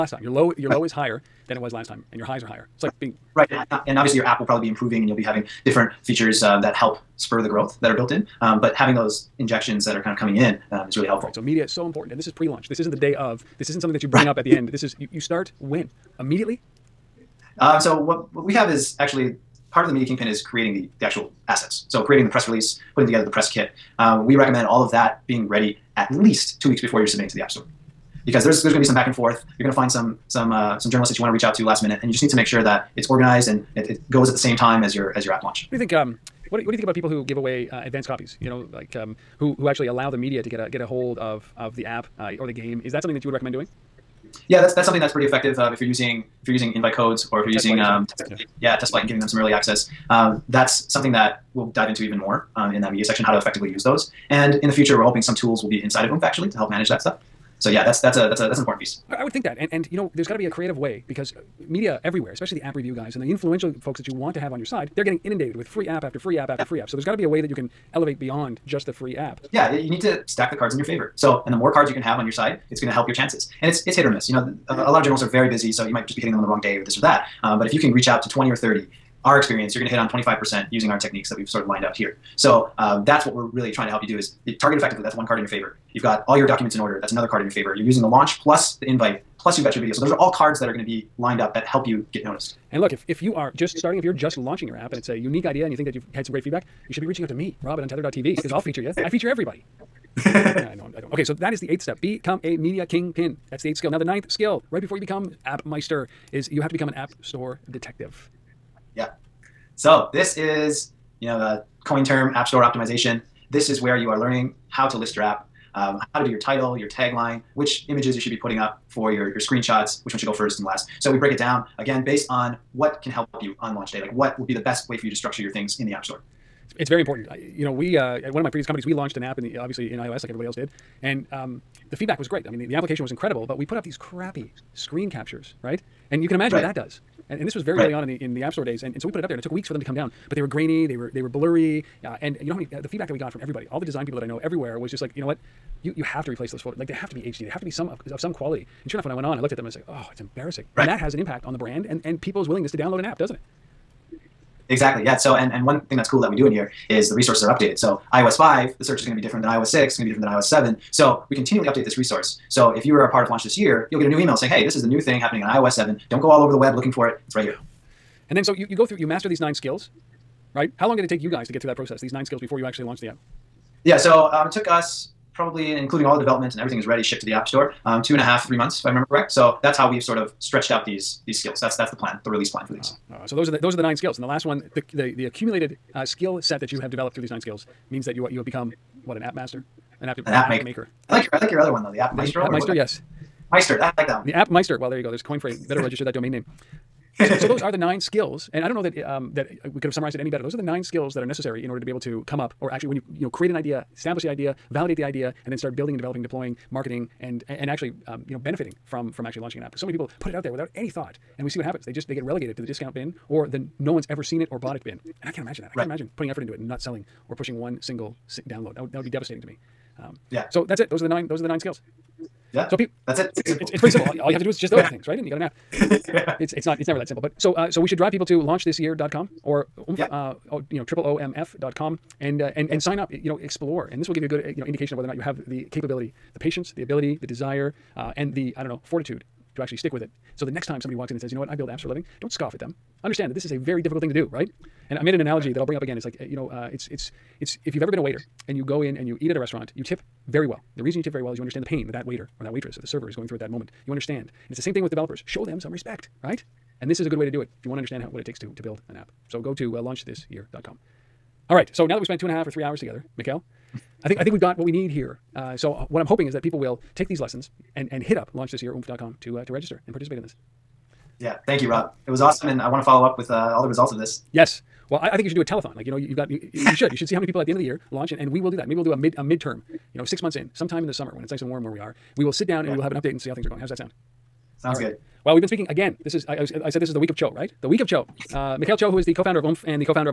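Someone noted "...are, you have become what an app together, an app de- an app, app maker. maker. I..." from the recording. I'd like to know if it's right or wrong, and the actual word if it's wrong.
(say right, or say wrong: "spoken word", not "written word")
wrong: "master", not "together".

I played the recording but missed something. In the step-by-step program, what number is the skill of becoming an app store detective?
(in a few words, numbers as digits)
9th.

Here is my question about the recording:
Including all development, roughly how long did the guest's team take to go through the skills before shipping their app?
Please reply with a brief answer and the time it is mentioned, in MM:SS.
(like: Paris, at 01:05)
2.5 to 3 months, at 02:58.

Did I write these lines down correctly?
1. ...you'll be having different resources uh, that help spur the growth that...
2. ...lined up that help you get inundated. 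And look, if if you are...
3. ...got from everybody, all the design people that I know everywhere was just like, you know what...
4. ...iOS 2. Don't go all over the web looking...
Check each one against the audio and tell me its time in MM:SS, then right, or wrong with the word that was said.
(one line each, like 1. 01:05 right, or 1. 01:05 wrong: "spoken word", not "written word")
1. 00:05 wrong: "features", not "resources"
2. 01:31 wrong: "noticed", not "inundated"
3. 02:23 right
4. 02:45 wrong: "7", not "2".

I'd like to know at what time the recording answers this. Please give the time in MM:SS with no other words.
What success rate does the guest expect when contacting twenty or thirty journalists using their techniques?
01:20.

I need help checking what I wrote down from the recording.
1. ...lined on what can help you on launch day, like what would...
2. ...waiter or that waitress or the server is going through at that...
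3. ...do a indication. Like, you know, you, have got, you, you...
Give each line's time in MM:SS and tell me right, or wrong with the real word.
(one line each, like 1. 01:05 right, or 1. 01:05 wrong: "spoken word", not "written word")
1. 02:02 wrong: "based", not "lined"
2. 04:12 right
3. 04:35 wrong: "telethon", not "indication".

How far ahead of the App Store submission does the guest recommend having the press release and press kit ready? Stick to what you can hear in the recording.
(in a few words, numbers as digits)
2 weeks.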